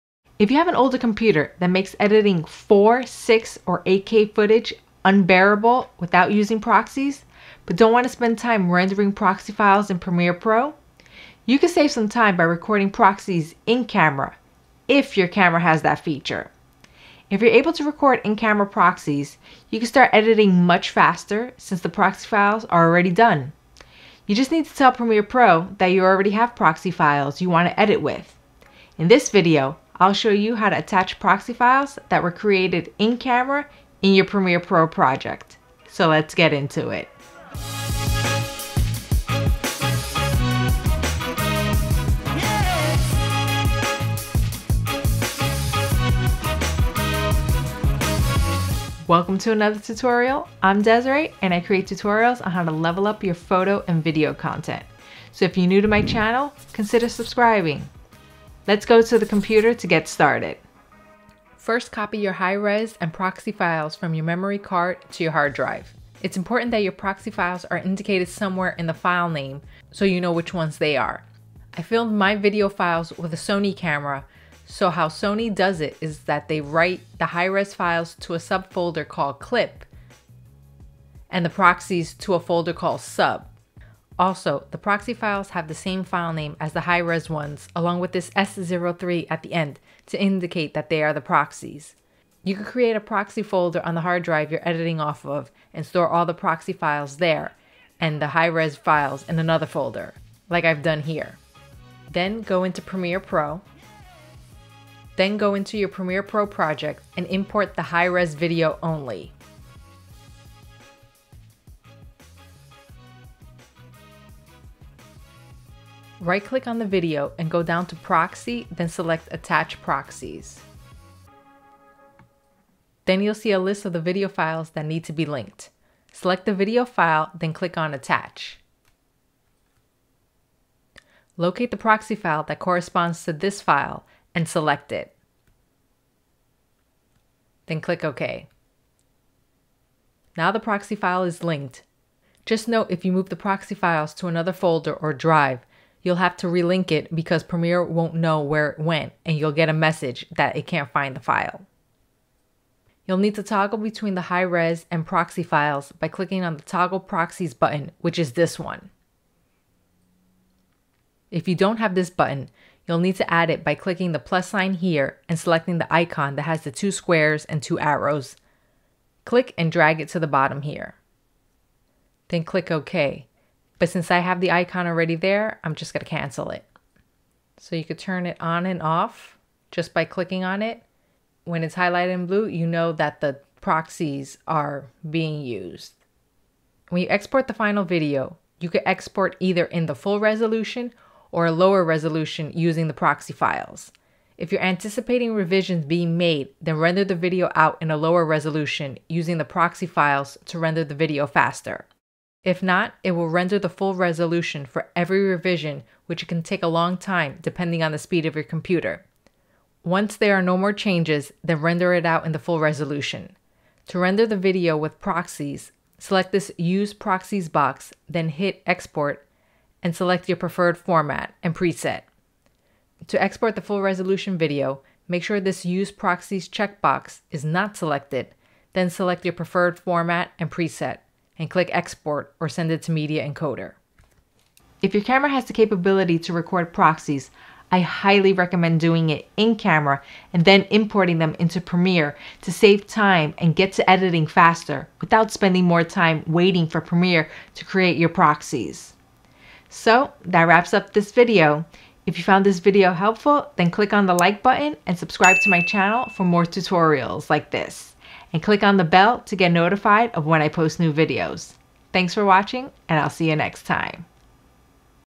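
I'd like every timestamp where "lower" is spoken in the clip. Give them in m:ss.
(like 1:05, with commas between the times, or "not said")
3:11, 3:17.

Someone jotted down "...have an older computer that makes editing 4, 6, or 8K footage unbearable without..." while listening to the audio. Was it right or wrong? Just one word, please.
right.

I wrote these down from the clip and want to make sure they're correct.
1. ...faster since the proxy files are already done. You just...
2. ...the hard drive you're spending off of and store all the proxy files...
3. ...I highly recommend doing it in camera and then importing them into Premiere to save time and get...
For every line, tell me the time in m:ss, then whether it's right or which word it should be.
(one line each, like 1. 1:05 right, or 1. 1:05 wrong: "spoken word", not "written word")
1. 0:20 right
2. 1:33 wrong: "editing", not "spending"
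3. 3:57 right.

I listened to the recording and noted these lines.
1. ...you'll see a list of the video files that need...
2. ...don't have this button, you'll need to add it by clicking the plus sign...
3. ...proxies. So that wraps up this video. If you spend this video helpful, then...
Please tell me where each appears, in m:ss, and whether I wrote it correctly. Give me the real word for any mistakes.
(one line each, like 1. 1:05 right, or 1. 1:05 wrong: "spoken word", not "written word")
1. 2:03 right
2. 2:41 right
3. 4:08 wrong: "found", not "spend".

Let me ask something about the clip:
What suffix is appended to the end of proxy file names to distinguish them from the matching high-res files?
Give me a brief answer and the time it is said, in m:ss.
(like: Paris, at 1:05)
S03, at 1:28.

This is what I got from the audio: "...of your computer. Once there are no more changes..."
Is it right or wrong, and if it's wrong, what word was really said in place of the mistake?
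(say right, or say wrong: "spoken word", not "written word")
right.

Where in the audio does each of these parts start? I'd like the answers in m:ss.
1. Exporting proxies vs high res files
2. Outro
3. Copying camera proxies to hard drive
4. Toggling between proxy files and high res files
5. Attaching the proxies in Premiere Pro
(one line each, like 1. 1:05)
1. 3:06
2. 3:54
3. 1:01
4. 2:32
5. 1:43.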